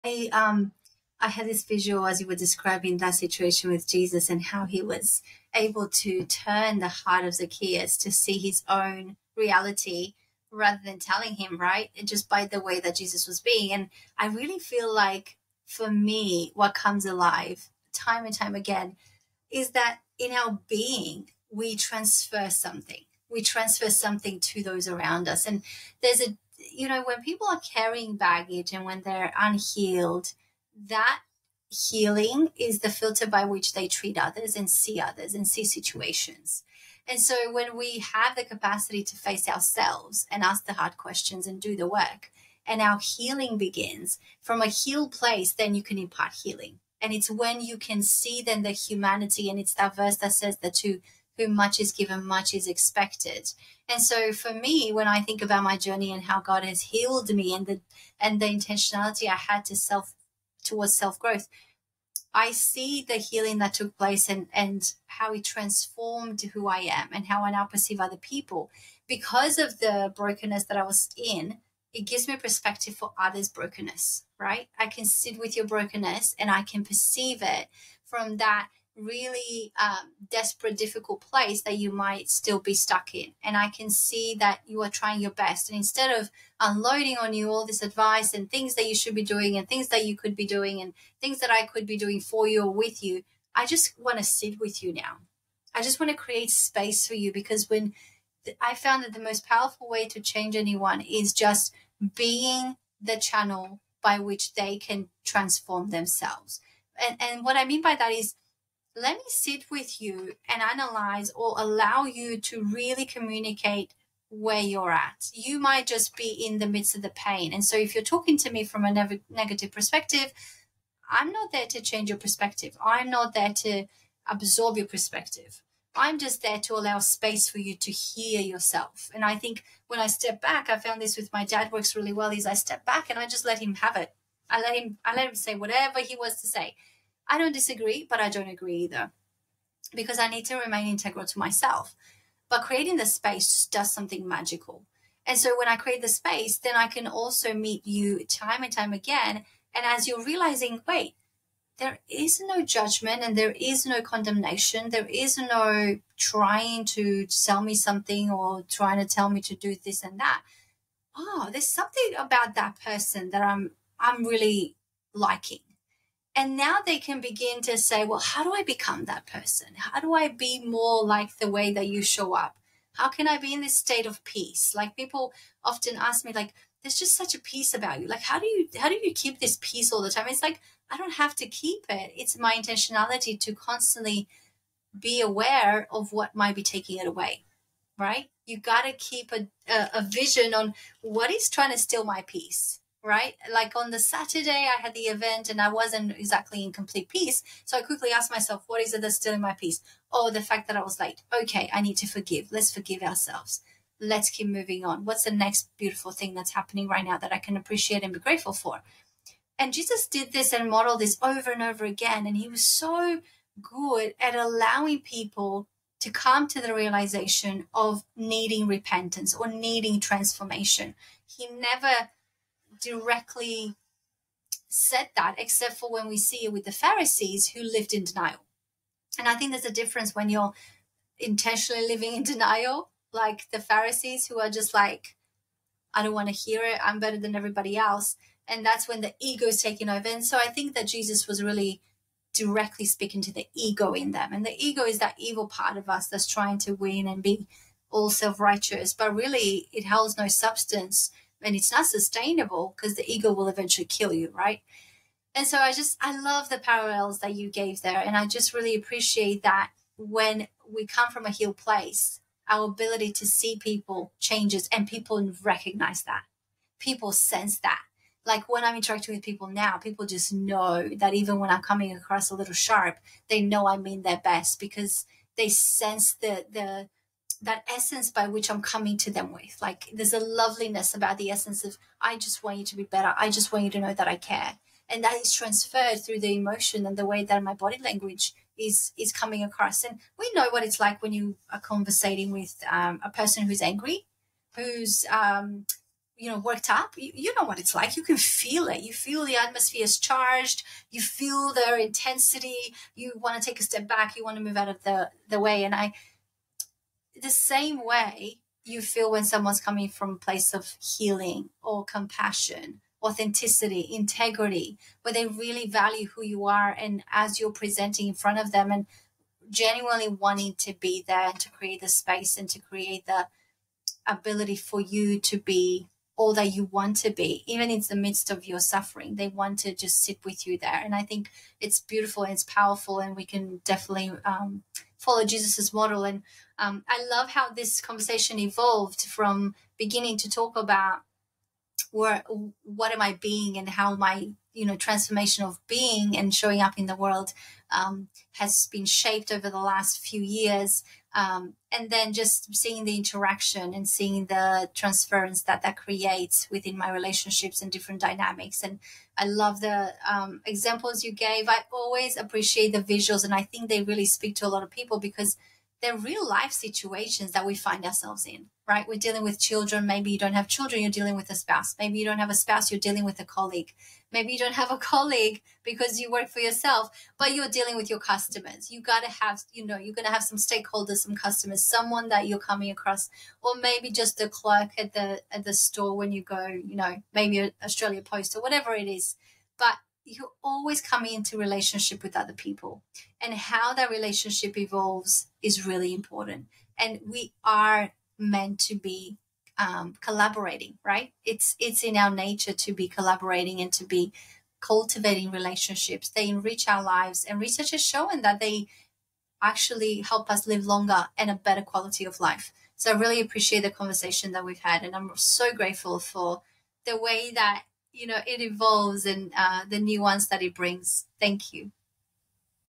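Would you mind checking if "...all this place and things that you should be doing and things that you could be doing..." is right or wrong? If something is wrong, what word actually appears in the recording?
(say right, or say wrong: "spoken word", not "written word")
wrong: "advice", not "place".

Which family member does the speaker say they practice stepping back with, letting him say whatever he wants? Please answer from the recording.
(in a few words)
Dad.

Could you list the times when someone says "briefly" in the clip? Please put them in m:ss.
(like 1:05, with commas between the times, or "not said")
not said.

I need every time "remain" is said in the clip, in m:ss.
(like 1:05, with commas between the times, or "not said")
2:20.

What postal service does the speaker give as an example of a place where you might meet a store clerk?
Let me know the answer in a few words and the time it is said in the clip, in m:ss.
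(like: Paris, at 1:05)
Australia Post, at 6:27.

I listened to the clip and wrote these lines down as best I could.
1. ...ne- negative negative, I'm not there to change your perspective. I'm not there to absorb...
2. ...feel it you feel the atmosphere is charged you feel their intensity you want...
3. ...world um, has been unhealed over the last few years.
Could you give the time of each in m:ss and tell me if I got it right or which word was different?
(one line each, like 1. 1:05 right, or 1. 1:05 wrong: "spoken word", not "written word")
1. 1:58 wrong: "perspective", not "negative"
2. 4:58 right
3. 5:46 wrong: "shaped", not "unhealed".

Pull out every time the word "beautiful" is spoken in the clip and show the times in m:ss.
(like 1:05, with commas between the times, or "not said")
3:25, 5:31.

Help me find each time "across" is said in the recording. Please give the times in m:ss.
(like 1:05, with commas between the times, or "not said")
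4:31, 4:49, 6:22.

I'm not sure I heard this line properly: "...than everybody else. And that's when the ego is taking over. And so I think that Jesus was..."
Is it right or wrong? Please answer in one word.
right.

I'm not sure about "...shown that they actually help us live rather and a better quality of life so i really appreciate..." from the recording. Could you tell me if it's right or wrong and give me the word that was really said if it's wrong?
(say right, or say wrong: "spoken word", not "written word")
wrong: "longer", not "rather".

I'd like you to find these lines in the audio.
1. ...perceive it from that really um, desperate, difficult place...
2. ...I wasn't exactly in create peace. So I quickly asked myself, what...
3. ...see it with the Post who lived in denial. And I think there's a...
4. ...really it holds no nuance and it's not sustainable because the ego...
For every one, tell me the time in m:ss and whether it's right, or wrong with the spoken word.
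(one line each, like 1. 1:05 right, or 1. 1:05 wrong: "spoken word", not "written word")
1. 1:16 right
2. 3:15 wrong: "complete", not "create"
3. 3:46 wrong: "Pharisees", not "Post"
4. 4:09 wrong: "substance", not "nuance".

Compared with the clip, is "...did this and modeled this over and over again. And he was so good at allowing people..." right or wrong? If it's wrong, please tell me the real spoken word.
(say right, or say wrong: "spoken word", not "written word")
right.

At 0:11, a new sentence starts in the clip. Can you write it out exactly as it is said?
And just by the way that Jesus was being.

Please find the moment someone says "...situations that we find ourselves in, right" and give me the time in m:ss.
6:06.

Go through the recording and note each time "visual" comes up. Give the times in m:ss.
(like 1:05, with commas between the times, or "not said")
0:01, 6:02.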